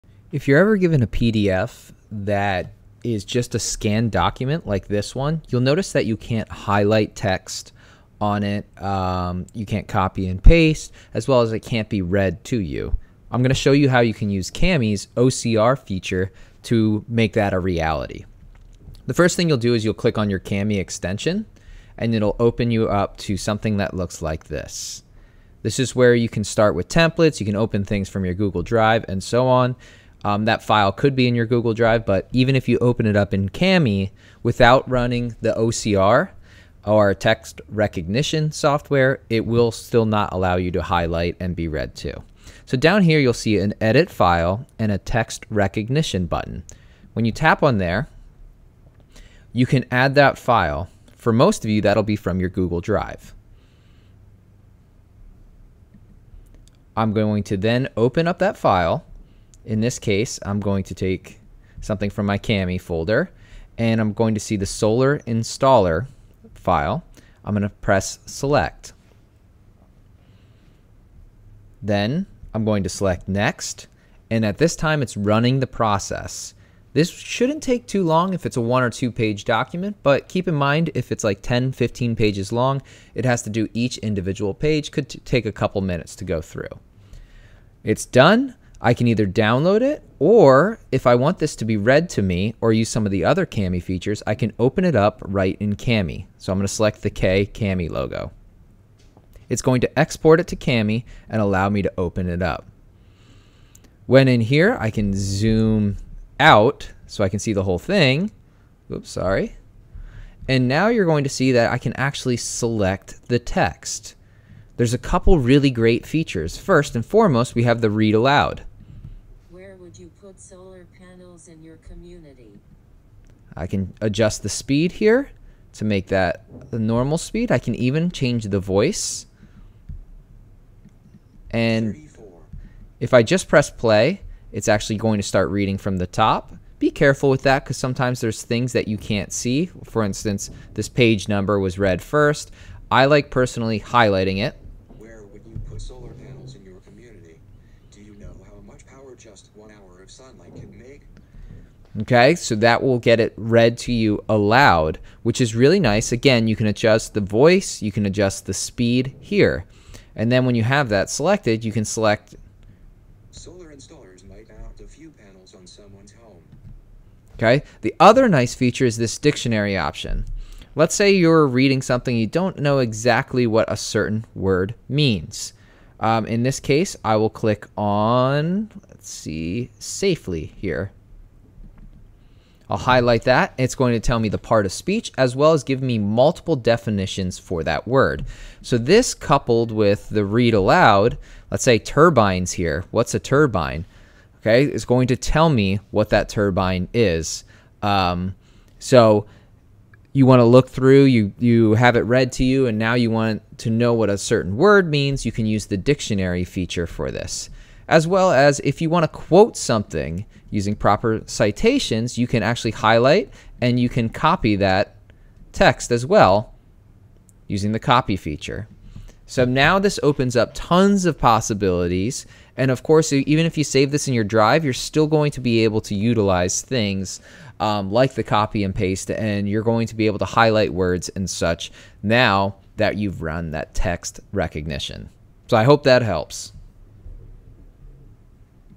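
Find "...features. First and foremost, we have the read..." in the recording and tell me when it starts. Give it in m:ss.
1:56.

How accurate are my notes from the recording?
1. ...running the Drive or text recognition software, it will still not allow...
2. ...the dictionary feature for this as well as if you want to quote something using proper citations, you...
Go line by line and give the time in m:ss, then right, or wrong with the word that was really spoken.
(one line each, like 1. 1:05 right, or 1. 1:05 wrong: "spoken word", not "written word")
1. 0:34 wrong: "OCR", not "Drive"
2. 3:25 right.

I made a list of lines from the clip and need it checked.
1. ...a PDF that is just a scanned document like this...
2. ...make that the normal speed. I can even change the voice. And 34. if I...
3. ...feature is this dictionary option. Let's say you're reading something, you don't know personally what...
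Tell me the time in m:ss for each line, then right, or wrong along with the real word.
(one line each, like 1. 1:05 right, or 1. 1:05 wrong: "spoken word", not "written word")
1. 0:01 right
2. 2:05 right
3. 2:48 wrong: "exactly", not "personally".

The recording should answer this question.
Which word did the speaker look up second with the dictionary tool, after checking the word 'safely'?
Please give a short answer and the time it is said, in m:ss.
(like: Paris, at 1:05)
turbines, at 3:11.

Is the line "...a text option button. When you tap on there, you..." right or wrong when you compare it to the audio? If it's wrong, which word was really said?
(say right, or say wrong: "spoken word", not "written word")
wrong: "recognition", not "option".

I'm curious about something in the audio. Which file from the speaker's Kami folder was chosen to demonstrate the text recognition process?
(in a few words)
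solar installer.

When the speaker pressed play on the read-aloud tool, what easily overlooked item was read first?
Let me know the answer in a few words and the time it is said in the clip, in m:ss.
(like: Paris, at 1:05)
page number, at 2:20.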